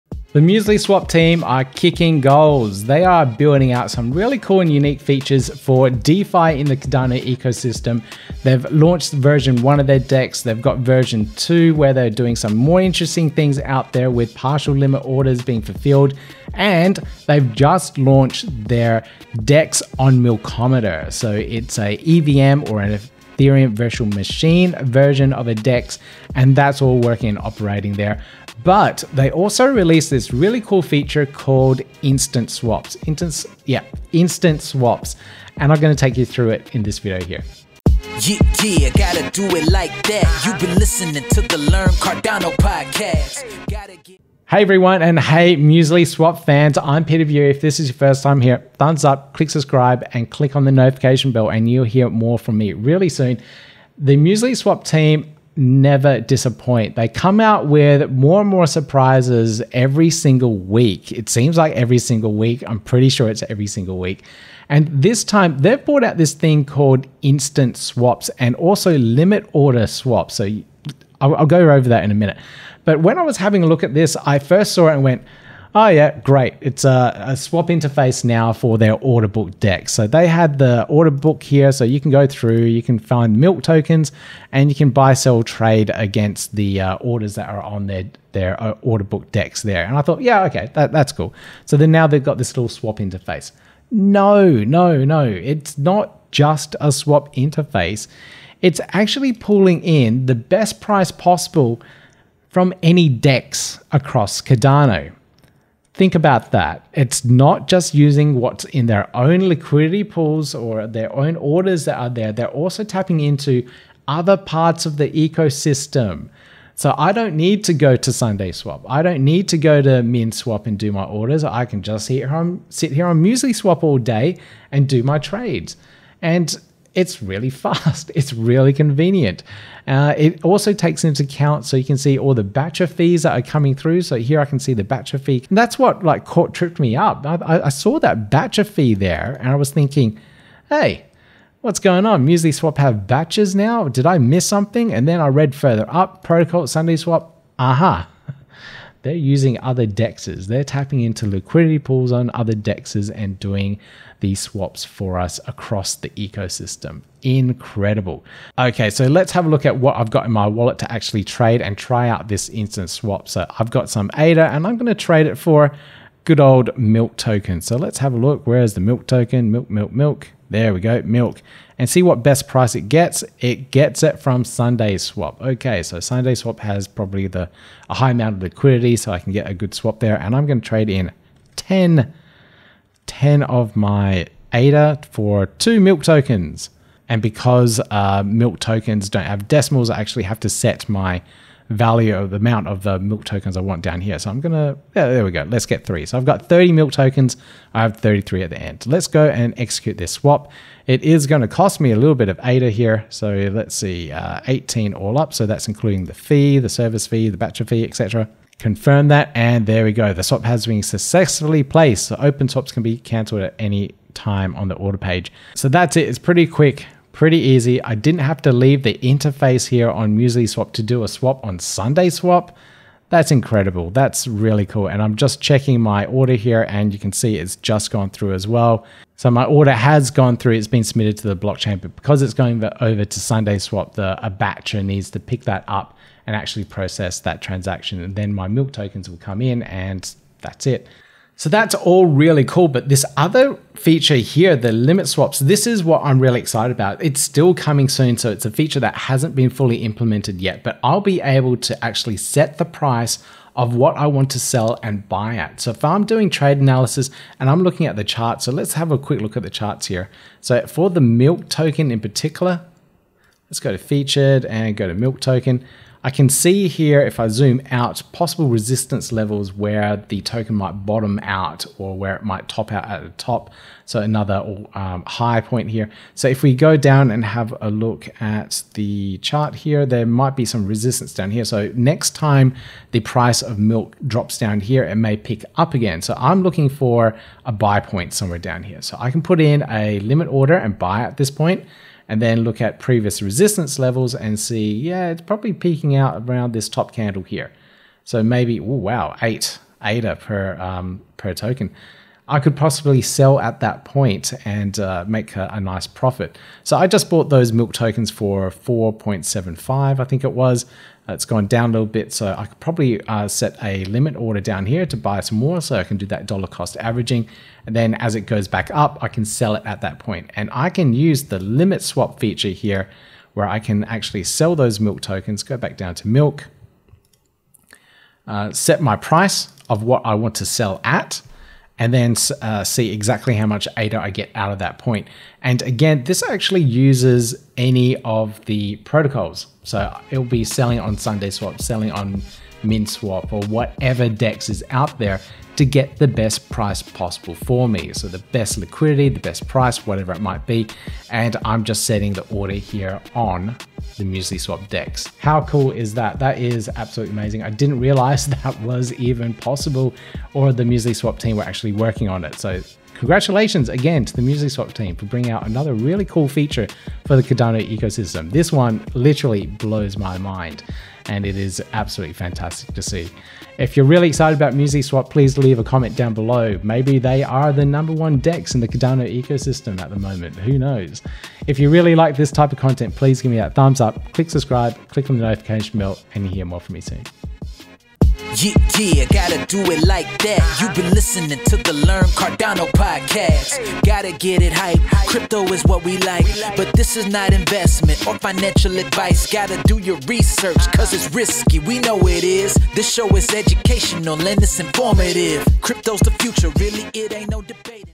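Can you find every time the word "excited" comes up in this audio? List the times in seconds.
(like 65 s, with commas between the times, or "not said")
246 s, 374 s.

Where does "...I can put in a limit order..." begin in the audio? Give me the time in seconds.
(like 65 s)
288 s.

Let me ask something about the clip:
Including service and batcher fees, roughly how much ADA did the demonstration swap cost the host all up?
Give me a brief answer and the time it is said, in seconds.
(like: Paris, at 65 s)
18, at 204 s.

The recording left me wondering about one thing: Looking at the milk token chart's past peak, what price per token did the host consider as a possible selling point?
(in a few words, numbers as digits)
8 ADA.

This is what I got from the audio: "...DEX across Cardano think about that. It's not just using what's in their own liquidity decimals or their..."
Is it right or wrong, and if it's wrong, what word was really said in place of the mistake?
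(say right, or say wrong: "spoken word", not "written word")
wrong: "pools", not "decimals".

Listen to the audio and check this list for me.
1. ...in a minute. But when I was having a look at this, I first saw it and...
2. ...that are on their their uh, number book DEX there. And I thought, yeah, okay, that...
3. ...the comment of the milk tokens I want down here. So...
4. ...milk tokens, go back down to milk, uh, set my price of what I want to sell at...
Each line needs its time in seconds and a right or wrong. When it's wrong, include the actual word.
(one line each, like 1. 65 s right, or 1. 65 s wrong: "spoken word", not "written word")
1. 72 s right
2. 87 s wrong: "order", not "number"
3. 192 s wrong: "amount", not "comment"
4. 324 s right.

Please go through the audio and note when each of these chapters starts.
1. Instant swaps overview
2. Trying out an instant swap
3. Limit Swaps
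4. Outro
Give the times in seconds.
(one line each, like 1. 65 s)
1. 65 s
2. 162 s
3. 241 s
4. 356 s.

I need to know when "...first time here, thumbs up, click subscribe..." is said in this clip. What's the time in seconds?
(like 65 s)
47 s.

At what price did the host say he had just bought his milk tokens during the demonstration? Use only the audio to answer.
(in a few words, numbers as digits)
4.75.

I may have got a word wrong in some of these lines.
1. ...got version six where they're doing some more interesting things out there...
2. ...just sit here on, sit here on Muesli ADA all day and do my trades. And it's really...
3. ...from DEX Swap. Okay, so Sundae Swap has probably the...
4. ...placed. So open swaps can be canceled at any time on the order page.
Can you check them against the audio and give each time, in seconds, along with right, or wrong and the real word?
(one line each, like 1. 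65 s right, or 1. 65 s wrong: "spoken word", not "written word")
1. 10 s wrong: "two", not "six"
2. 121 s wrong: "Swap", not "ADA"
3. 174 s wrong: "Sundae", not "DEX"
4. 211 s right.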